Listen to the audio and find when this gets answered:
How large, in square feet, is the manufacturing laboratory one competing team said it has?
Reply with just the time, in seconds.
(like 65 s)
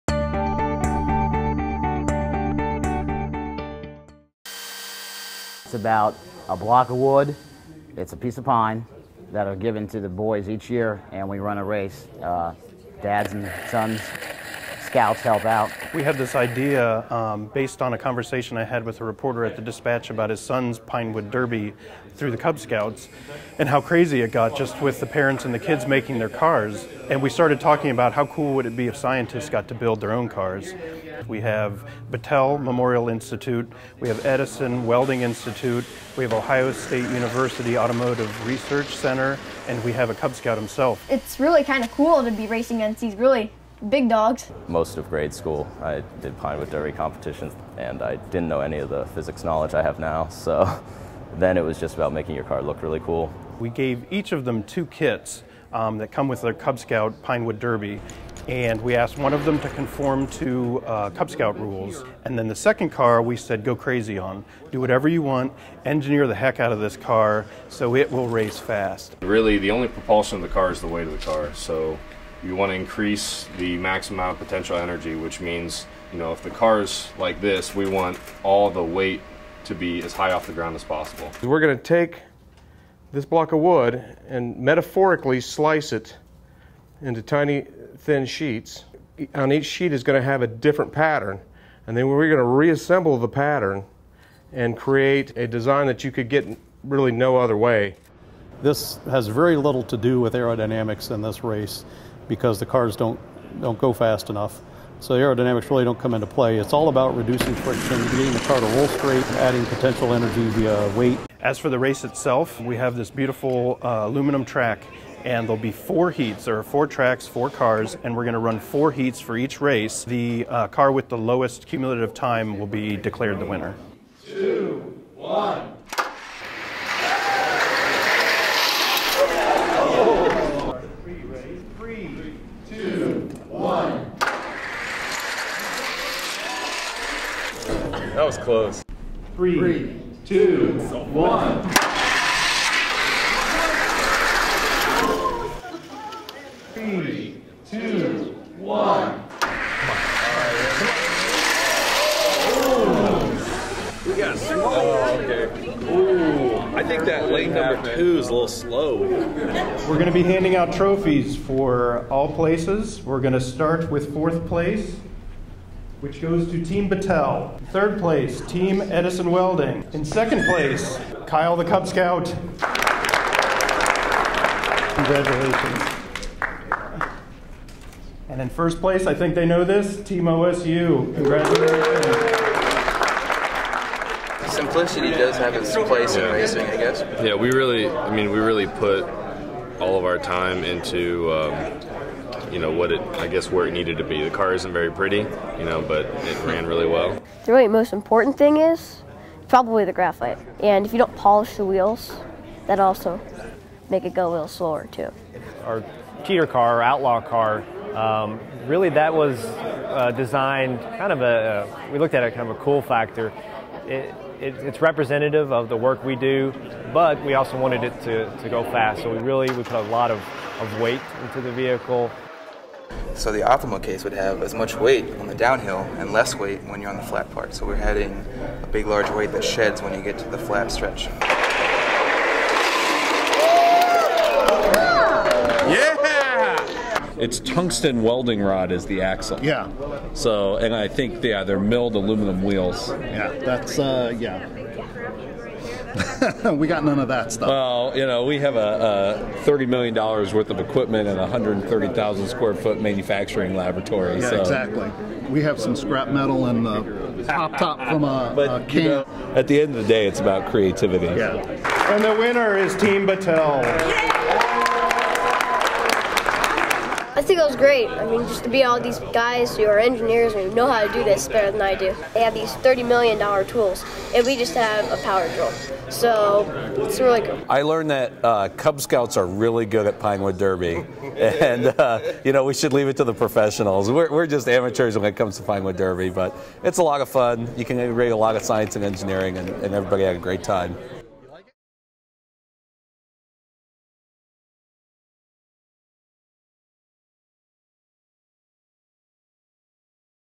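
251 s.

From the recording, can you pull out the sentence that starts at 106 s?
It's all about reducing friction, getting the car to roll straight, adding potential energy via weight.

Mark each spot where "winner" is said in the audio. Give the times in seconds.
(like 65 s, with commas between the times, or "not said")
123 s, 262 s.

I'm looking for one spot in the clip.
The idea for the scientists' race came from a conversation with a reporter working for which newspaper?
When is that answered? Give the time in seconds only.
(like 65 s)
19 s.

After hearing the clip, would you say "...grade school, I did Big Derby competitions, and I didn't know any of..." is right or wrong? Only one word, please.
wrong.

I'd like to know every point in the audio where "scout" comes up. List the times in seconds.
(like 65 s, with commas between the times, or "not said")
14 s, 22 s, 40 s, 56 s, 61 s, 171 s, 278 s.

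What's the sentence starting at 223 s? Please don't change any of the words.
So the optimal case would have as much weight on the downhill and less weight when you're on the flat part.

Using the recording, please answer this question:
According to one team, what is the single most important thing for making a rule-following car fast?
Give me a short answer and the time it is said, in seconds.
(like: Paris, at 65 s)
graphite, at 199 s.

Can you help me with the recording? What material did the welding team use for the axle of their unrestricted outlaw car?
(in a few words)
tungsten welding rod.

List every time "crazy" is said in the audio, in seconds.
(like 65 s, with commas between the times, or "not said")
23 s, 63 s.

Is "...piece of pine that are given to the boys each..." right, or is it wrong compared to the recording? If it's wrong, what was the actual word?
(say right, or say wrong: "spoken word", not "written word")
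right.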